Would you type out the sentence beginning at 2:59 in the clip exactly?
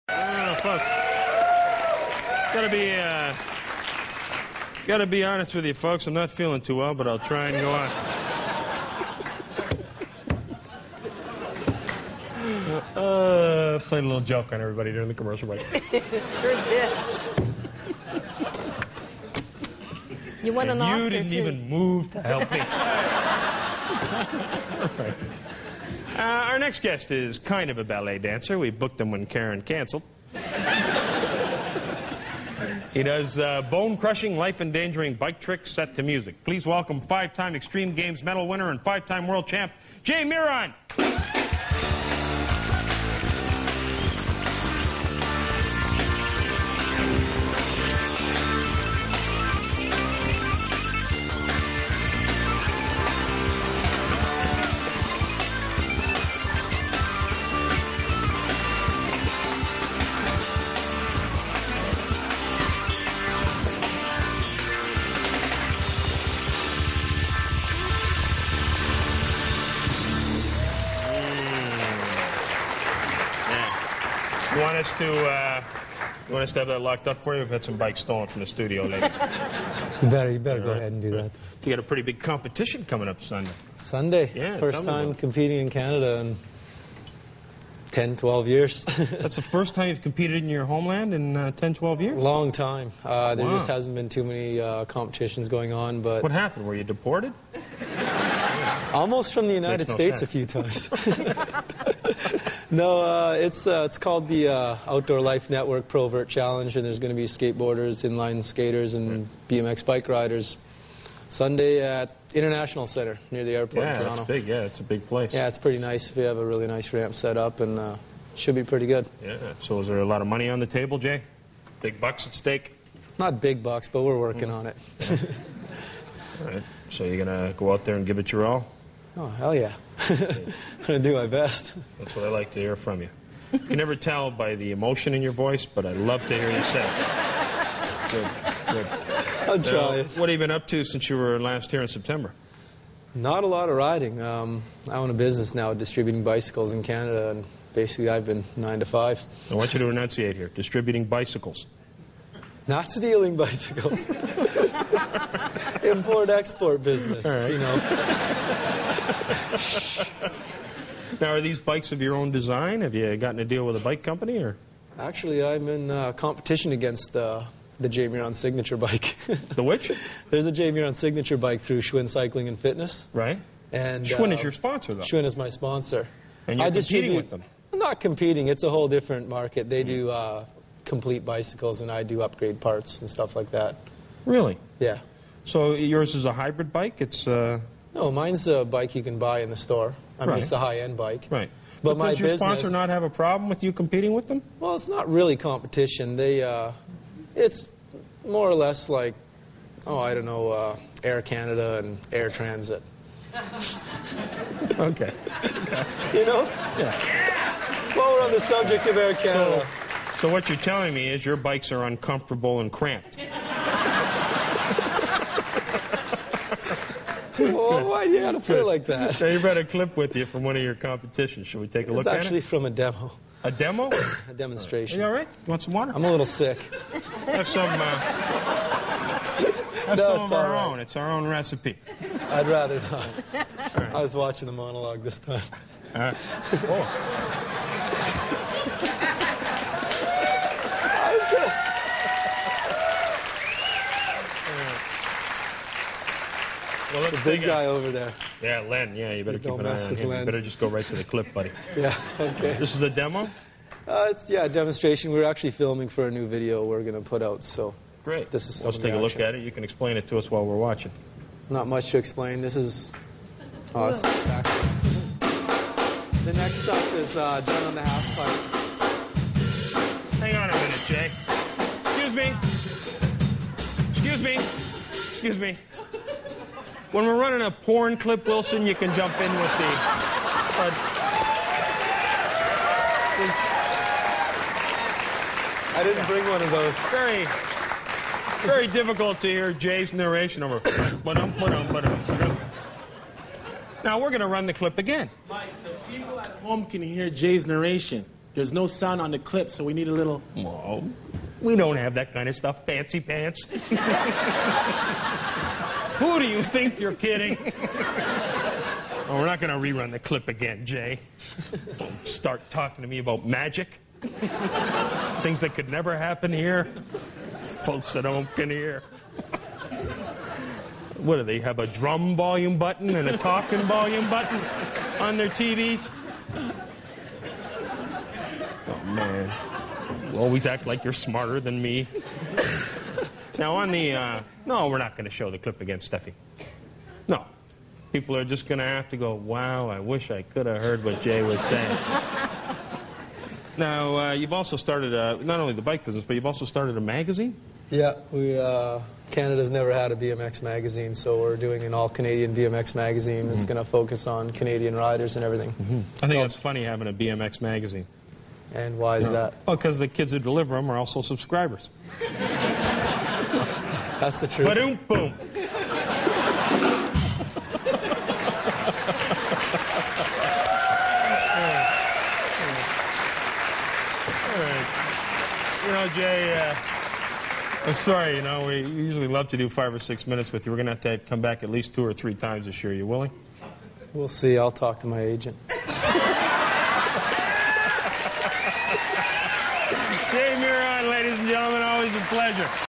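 They do uh, complete bicycles, and I do upgrade parts and stuff like that.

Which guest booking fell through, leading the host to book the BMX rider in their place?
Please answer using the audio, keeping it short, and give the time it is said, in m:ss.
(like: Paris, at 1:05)
Karen, at 0:29.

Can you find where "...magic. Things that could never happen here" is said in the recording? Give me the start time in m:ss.
5:13.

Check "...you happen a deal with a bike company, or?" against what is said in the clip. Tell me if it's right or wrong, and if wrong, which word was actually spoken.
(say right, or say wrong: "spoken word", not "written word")
wrong: "gotten", not "happen".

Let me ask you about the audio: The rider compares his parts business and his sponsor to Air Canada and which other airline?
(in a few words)
Air Transat.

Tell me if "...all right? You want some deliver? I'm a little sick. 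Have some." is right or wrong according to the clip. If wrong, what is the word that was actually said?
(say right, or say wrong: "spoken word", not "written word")
wrong: "water", not "deliver".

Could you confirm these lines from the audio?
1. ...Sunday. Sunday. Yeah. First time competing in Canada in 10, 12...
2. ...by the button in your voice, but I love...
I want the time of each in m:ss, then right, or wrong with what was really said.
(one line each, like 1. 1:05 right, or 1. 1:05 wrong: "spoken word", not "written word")
1. 1:23 right
2. 2:14 wrong: "emotion", not "button".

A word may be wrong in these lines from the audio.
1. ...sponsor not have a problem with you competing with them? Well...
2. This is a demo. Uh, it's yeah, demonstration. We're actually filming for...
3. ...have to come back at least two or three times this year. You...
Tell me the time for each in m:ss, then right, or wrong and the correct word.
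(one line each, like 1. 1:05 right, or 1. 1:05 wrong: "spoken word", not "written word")
1. 3:12 right
2. 4:12 right
3. 6:20 right.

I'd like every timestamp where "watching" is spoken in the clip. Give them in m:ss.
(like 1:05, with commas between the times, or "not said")
3:54, 4:20.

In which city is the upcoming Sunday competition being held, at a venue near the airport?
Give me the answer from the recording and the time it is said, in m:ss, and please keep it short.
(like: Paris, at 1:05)
Toronto, at 1:54.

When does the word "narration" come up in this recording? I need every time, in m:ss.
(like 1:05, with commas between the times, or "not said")
4:49, 4:57.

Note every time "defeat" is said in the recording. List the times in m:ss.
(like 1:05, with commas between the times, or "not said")
not said.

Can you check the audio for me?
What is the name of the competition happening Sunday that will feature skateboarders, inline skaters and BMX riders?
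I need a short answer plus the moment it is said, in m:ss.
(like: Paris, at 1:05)
Outdoor Life Network Provert Challenge, at 1:44.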